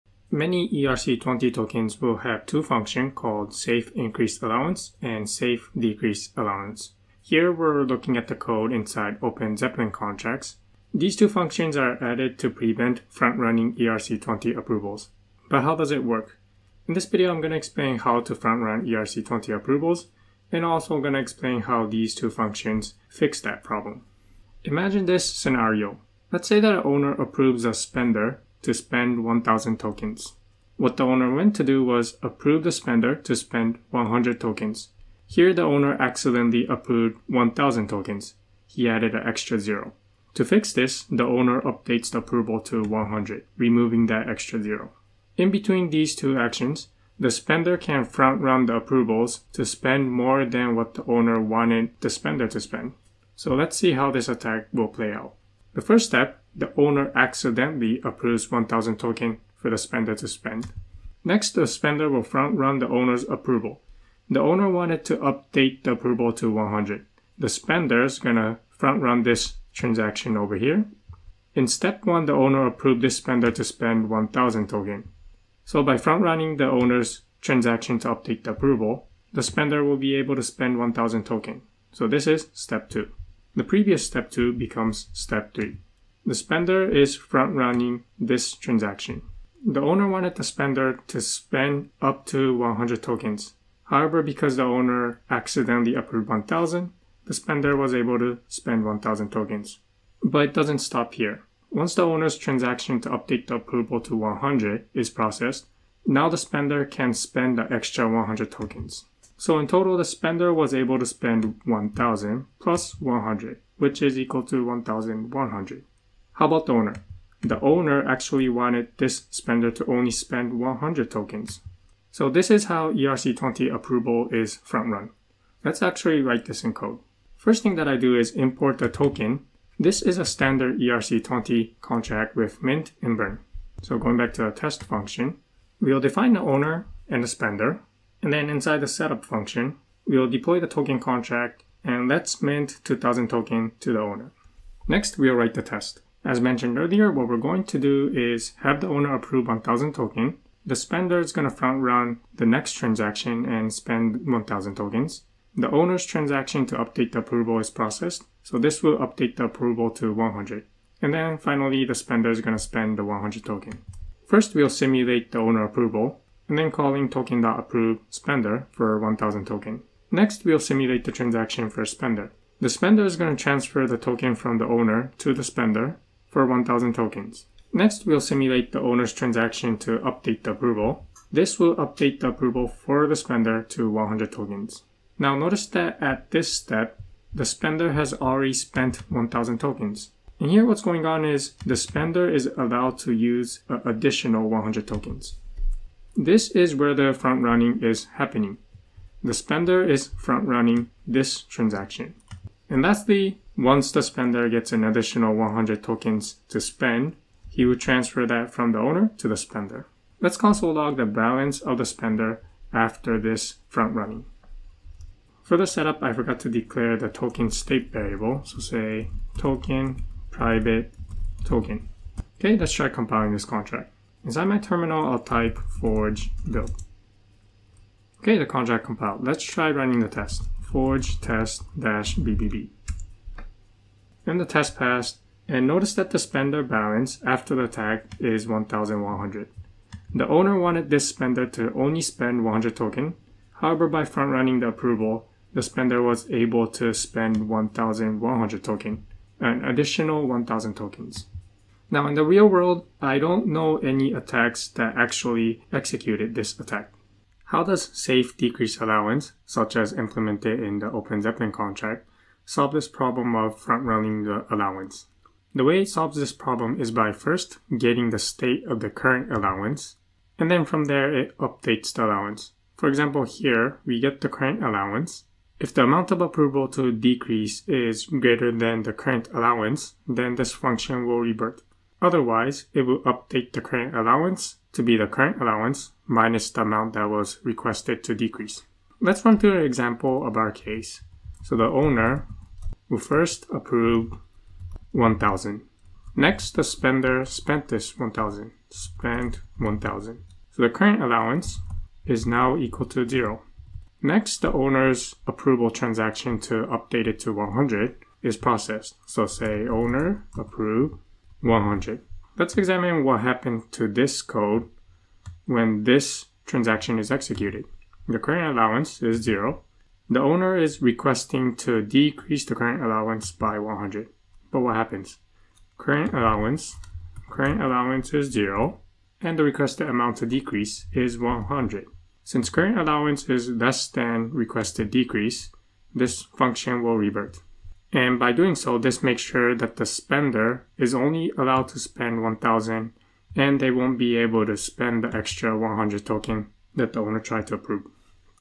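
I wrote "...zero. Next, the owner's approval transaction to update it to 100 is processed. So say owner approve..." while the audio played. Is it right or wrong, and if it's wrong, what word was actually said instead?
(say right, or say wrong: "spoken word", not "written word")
right.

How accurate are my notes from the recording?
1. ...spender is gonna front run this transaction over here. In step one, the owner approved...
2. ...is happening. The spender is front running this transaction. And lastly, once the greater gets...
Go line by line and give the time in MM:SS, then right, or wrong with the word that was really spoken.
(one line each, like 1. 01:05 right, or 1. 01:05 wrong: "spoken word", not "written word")
1. 01:07 right
2. 03:17 wrong: "spender", not "greater".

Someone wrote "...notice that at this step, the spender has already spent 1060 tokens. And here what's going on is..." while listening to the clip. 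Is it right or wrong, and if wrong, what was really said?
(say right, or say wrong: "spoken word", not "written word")
wrong: "1000", not "1060".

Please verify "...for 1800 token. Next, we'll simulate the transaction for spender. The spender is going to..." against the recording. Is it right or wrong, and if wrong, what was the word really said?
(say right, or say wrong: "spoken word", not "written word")
wrong: "1000", not "1800".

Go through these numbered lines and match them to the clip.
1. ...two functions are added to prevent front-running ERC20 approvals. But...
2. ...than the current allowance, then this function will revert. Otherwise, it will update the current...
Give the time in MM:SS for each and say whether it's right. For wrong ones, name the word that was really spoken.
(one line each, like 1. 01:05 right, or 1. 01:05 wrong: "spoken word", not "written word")
1. 00:11 right
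2. 04:38 right.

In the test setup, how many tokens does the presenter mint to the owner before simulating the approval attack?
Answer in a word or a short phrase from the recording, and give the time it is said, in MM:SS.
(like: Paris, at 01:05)
2000, at 02:22.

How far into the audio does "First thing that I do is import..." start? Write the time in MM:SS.
02:07.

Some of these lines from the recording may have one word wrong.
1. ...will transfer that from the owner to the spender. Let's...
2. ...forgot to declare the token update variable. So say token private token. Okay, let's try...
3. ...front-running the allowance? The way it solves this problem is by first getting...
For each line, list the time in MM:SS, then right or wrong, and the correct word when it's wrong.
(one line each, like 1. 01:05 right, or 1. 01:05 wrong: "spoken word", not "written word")
1. 03:27 right
2. 03:36 wrong: "state", not "update"
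3. 04:23 right.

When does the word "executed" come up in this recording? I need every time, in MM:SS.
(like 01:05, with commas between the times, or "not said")
04:15, 05:17.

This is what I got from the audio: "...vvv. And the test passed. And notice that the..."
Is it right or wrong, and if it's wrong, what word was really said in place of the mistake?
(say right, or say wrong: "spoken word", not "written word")
right.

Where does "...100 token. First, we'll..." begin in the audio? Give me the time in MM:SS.
02:43.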